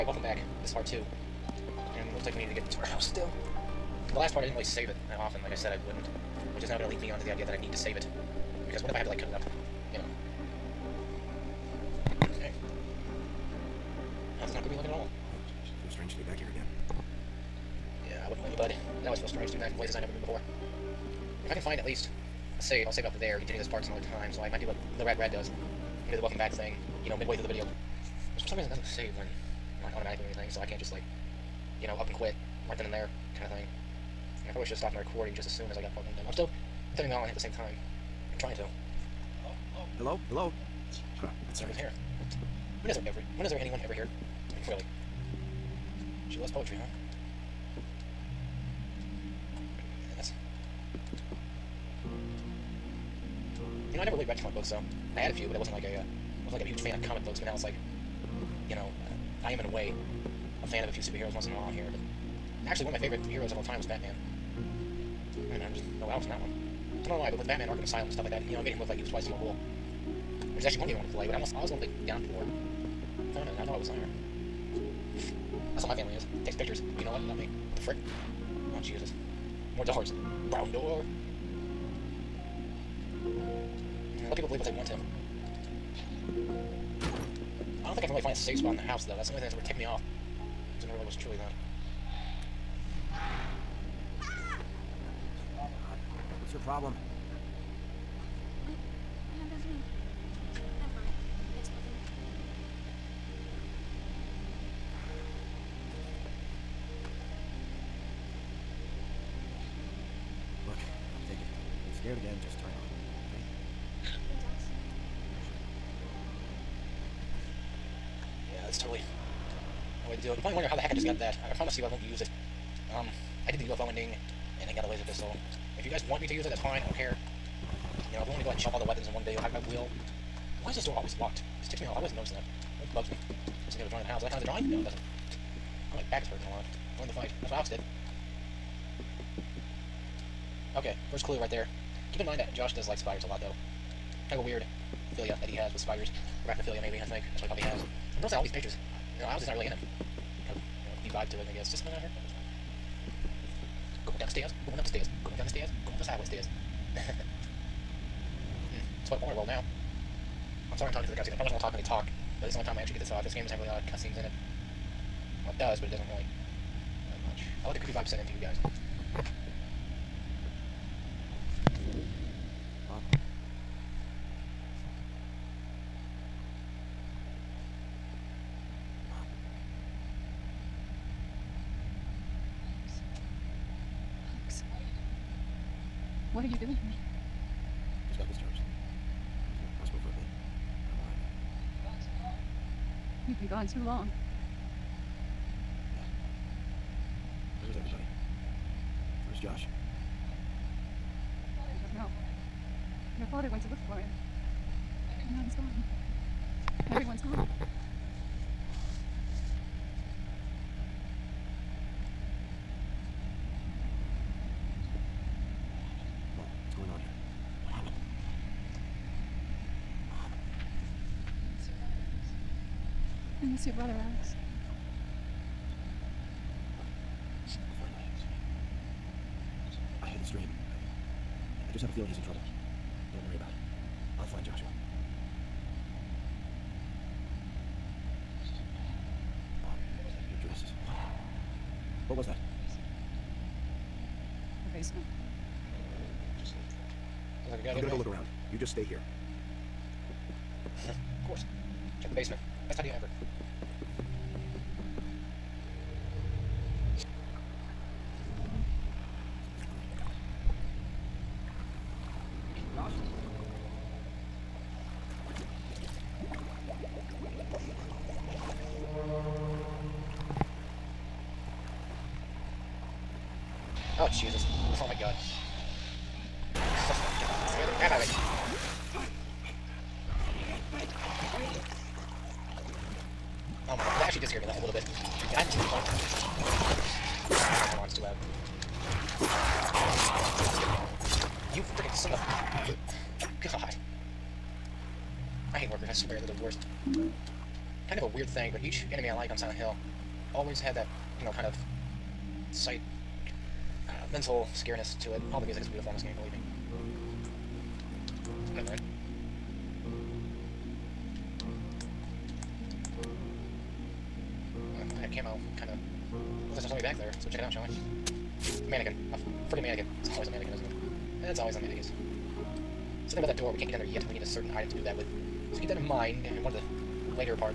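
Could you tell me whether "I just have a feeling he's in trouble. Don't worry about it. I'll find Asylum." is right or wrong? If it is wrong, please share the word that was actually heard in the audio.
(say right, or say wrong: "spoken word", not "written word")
wrong: "Joshua", not "Asylum".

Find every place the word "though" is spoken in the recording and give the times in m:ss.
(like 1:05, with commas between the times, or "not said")
1:29, 2:23.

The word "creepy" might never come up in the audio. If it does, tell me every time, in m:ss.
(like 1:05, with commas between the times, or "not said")
0:14, 2:47.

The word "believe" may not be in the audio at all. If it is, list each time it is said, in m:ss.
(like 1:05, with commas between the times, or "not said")
1:24, 5:06.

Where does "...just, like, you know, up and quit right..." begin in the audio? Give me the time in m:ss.
0:30.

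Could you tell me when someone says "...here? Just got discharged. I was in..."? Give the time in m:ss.
3:06.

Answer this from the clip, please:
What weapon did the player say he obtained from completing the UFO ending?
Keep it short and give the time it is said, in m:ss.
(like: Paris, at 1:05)
laser pistol, at 2:04.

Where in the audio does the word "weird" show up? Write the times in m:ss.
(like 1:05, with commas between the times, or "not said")
2:24, 4:58.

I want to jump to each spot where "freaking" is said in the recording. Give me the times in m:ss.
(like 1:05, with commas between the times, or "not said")
4:51, 5:19.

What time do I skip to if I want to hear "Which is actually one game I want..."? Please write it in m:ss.
1:10.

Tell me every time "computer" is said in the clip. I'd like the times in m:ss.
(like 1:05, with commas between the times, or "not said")
not said.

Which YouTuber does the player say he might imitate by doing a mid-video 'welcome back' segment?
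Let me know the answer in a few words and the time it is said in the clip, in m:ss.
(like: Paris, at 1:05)
Rad Brad, at 0:25.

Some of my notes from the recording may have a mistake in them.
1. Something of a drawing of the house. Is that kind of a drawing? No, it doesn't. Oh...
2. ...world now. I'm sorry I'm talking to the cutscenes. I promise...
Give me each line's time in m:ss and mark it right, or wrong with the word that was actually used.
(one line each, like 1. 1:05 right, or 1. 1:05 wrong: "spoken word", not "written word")
1. 2:13 right
2. 2:39 right.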